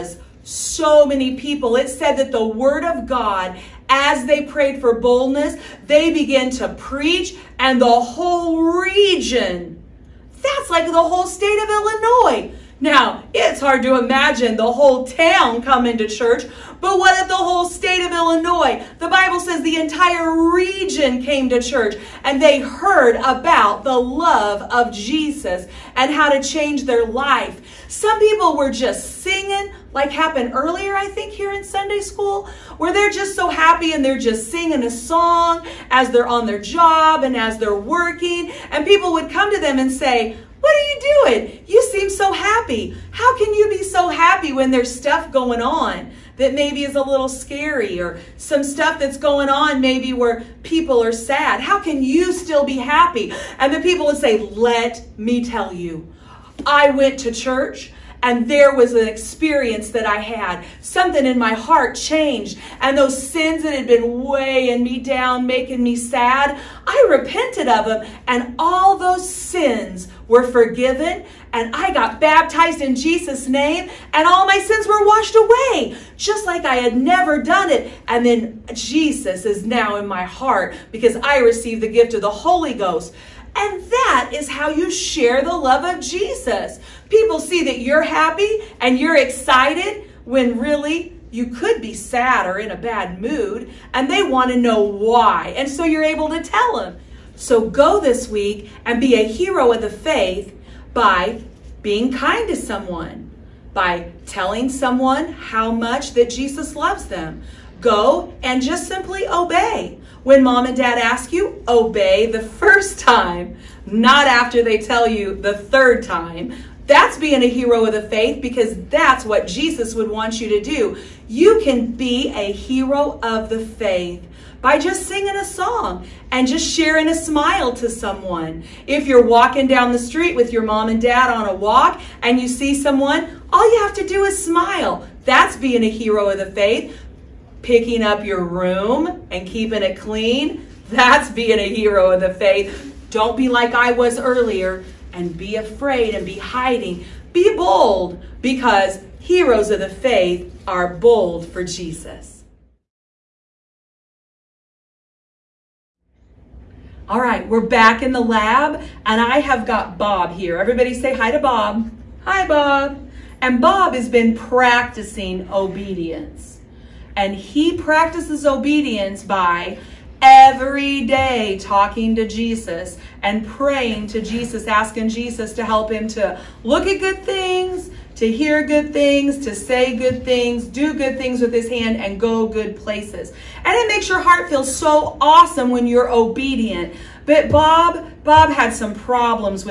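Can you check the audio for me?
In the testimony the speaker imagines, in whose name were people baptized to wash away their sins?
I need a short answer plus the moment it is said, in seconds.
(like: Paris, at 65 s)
Jesus' name, at 72 s.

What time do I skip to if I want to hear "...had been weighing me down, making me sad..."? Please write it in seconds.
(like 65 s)
63 s.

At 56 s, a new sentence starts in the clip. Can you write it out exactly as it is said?
I went to church and there was an experience that I had.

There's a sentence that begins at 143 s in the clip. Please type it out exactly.
Don't be like I was earlier and be afraid and be hiding.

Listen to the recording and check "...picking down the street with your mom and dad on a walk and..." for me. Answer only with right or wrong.
wrong.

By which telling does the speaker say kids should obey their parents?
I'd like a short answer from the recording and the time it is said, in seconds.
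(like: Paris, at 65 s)
first time, at 112 s.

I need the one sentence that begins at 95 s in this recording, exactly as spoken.
And so you're able to tell them.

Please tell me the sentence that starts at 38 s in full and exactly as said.
And people would come to them and say, what are you doing?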